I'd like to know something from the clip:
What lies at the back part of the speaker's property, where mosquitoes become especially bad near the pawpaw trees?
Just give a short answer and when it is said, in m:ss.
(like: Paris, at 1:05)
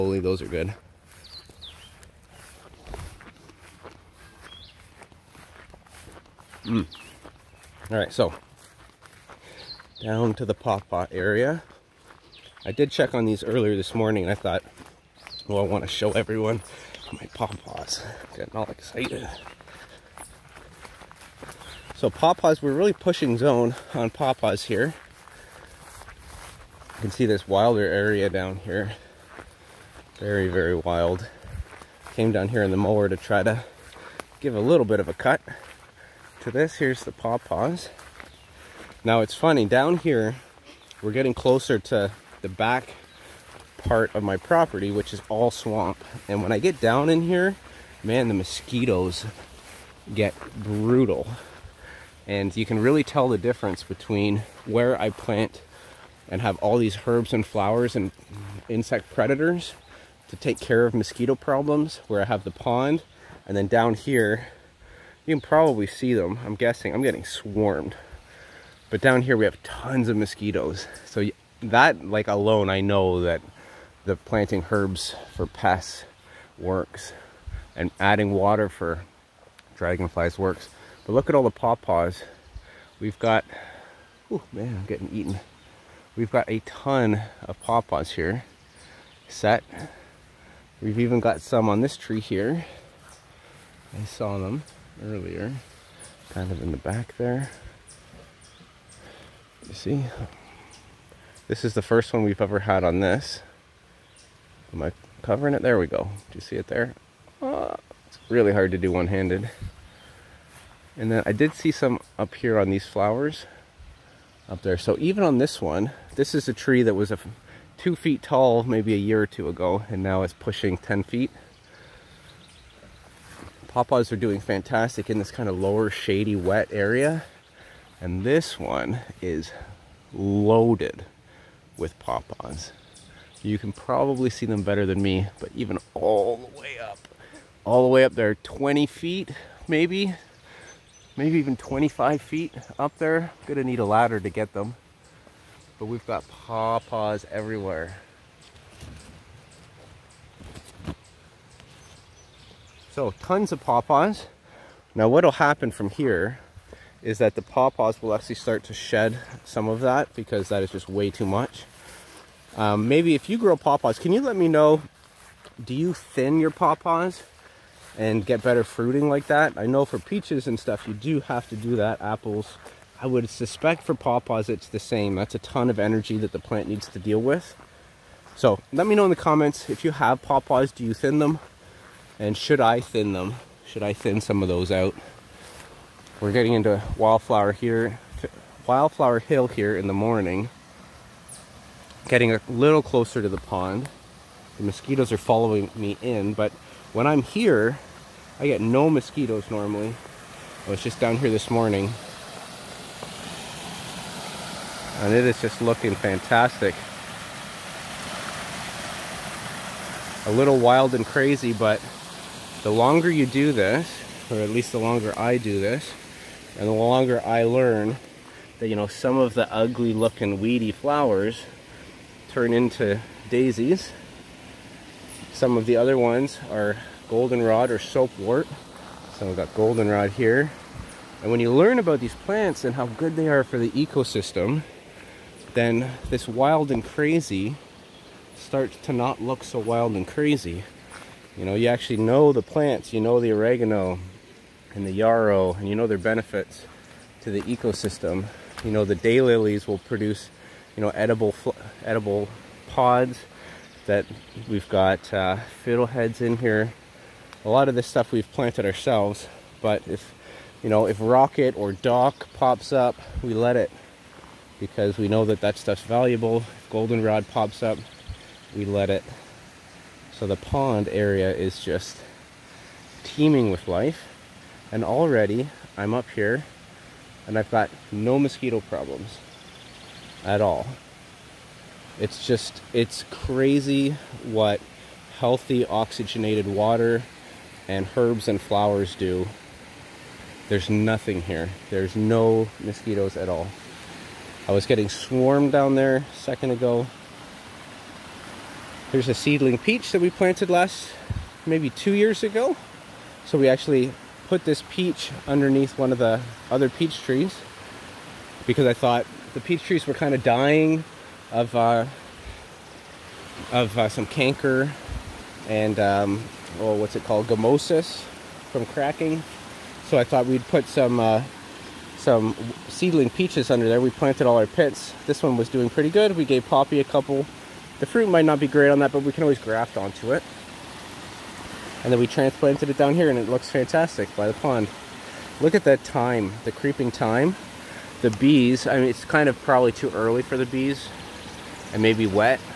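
Swamp, at 0:45.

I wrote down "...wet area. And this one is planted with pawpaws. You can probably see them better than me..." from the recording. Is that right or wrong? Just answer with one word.
wrong.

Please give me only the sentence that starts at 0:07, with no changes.
All right, so down to the pawpaw area.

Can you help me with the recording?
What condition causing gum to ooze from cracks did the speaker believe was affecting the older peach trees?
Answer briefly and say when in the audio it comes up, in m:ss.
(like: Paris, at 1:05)
Gummosis, at 5:17.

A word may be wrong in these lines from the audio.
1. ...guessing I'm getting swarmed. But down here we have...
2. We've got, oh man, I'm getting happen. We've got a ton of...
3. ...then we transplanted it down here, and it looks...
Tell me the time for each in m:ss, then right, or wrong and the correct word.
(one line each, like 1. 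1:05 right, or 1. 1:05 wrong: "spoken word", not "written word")
1. 1:06 right
2. 1:22 wrong: "eaten", not "happen"
3. 5:31 right.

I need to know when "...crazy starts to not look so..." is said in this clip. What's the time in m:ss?
3:56.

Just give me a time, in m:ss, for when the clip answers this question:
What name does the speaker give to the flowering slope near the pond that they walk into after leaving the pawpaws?
3:08.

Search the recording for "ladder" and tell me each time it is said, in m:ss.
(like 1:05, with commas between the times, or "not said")
2:23.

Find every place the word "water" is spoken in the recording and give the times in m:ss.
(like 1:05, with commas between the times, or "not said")
1:18, 4:46.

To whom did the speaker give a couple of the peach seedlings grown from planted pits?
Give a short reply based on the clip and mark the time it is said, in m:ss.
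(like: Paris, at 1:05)
Poppy, at 5:26.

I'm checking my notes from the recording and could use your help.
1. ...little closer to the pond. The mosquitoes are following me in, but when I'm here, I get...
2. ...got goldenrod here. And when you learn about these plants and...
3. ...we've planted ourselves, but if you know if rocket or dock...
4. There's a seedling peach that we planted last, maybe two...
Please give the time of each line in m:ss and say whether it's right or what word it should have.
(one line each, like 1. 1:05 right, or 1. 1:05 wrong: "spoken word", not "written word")
1. 3:12 right
2. 3:49 right
3. 4:18 right
4. 4:58 right.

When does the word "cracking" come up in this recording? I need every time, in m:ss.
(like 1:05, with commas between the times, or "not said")
5:18.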